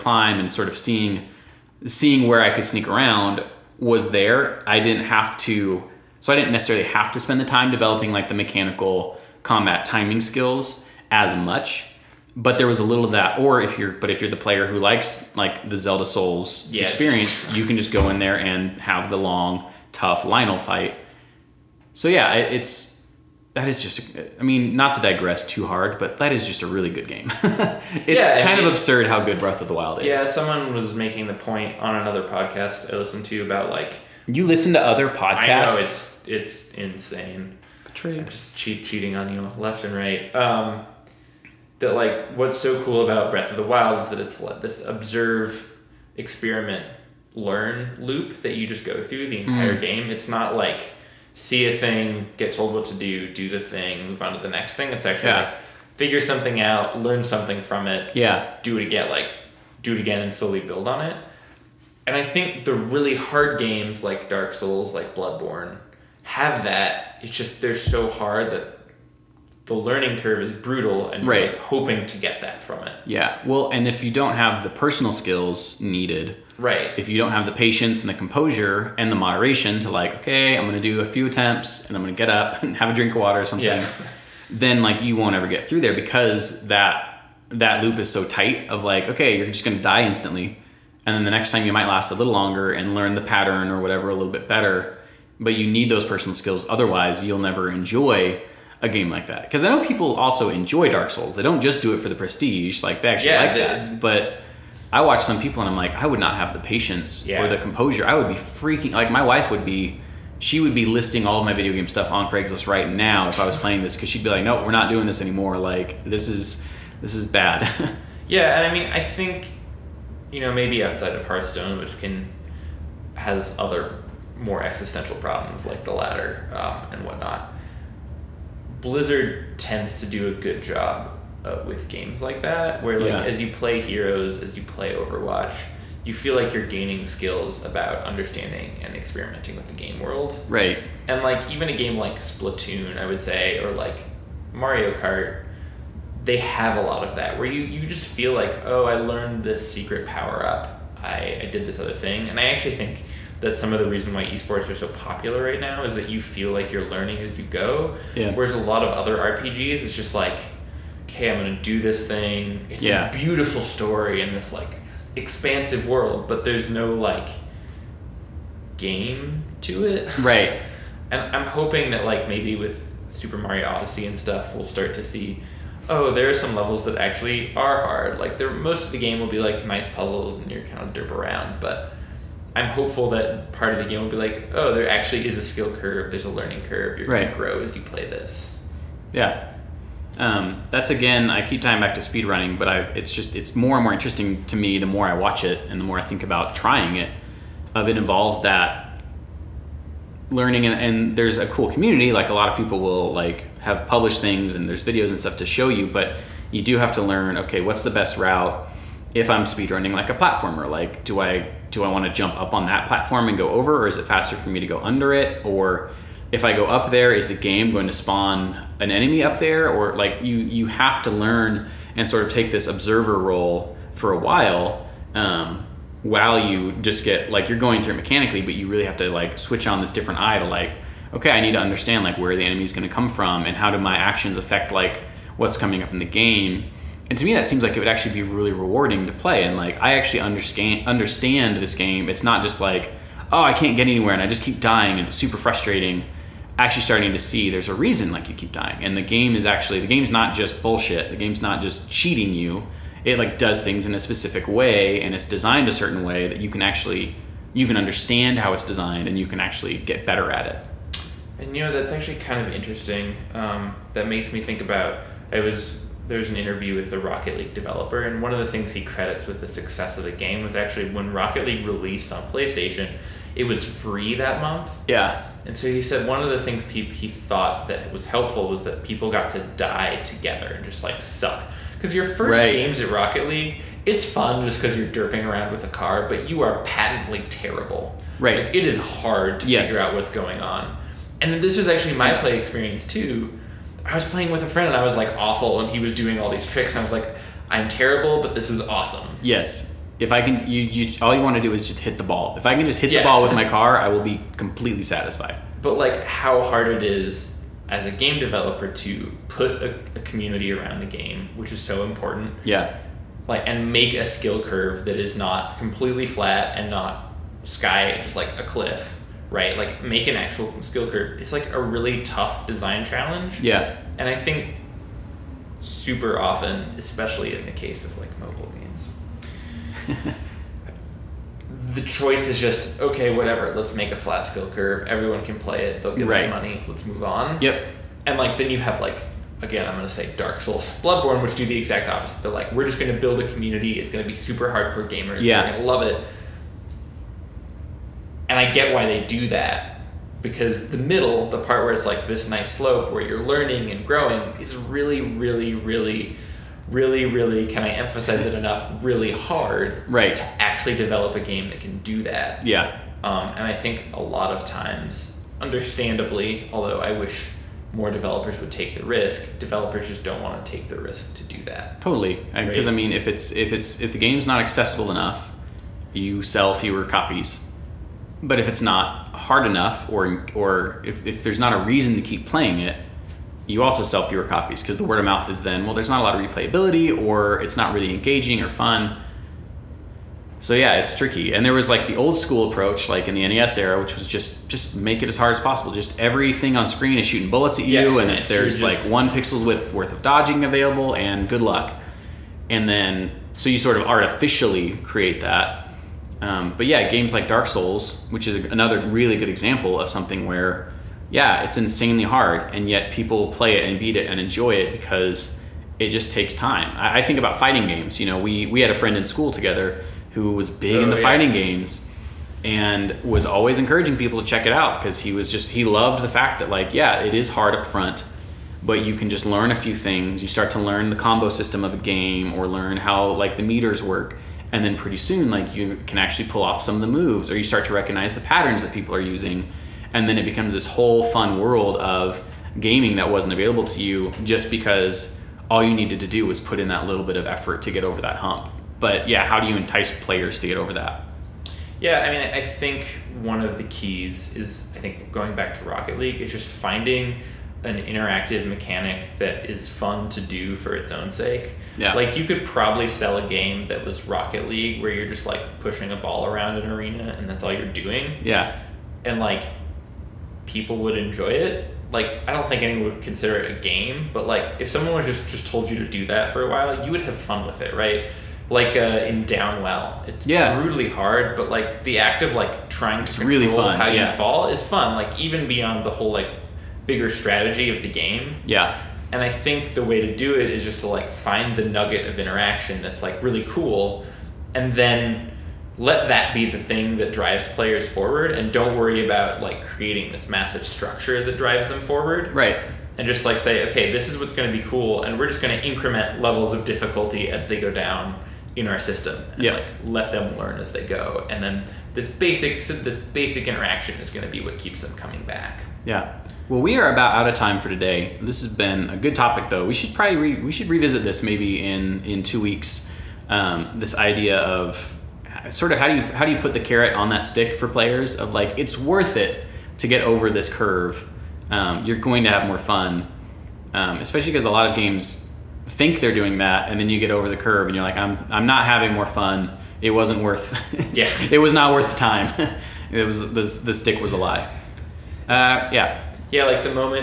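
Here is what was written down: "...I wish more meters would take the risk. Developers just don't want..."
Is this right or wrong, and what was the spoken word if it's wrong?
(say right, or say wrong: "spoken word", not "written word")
wrong: "developers", not "meters".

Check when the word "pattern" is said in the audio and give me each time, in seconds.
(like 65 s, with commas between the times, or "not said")
93 s, 438 s.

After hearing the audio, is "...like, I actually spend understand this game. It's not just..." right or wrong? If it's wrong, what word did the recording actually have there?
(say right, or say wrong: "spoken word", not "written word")
wrong: "understand", not "spend".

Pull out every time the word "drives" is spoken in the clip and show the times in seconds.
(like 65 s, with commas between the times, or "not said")
497 s, 501 s.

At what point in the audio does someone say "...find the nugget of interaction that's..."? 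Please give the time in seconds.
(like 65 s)
491 s.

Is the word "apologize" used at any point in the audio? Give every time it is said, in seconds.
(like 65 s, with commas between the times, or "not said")
not said.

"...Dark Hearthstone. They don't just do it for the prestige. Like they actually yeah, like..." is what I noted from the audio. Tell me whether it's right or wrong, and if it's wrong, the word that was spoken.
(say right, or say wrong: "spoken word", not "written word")
wrong: "Souls", not "Hearthstone".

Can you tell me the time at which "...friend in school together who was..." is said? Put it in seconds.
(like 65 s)
418 s.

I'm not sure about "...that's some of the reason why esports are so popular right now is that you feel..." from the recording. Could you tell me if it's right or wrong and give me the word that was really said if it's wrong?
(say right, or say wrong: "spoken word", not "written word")
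right.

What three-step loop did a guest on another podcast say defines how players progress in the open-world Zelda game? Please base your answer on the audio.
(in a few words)
observe experiment learn.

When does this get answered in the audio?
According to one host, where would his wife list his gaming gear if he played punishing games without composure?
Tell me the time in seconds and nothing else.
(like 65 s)
112 s.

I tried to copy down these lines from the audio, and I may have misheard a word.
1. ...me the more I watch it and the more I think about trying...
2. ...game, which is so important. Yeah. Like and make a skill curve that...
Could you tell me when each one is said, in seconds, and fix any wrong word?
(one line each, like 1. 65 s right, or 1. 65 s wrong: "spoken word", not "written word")
1. 194 s right
2. 310 s right.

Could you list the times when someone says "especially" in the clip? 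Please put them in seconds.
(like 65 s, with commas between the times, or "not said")
326 s, 533 s.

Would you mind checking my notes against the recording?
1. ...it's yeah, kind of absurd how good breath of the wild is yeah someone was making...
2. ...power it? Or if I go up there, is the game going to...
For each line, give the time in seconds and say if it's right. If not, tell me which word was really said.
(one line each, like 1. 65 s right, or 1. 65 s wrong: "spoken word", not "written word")
1. 27 s right
2. 214 s wrong: "under", not "power".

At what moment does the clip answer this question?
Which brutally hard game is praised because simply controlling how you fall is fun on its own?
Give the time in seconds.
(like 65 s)
479 s.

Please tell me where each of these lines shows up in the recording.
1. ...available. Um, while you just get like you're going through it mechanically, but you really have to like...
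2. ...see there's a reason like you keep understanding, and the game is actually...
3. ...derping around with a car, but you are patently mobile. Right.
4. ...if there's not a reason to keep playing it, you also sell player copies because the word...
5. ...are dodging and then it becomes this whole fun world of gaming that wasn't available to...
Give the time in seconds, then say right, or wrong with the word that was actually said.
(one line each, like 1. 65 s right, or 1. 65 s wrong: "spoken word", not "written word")
1. 224 s wrong: "while", not "available"
2. 247 s wrong: "dying", not "understanding"
3. 284 s wrong: "terrible", not "mobile"
4. 381 s wrong: "fewer", not "player"
5. 438 s wrong: "using", not "dodging".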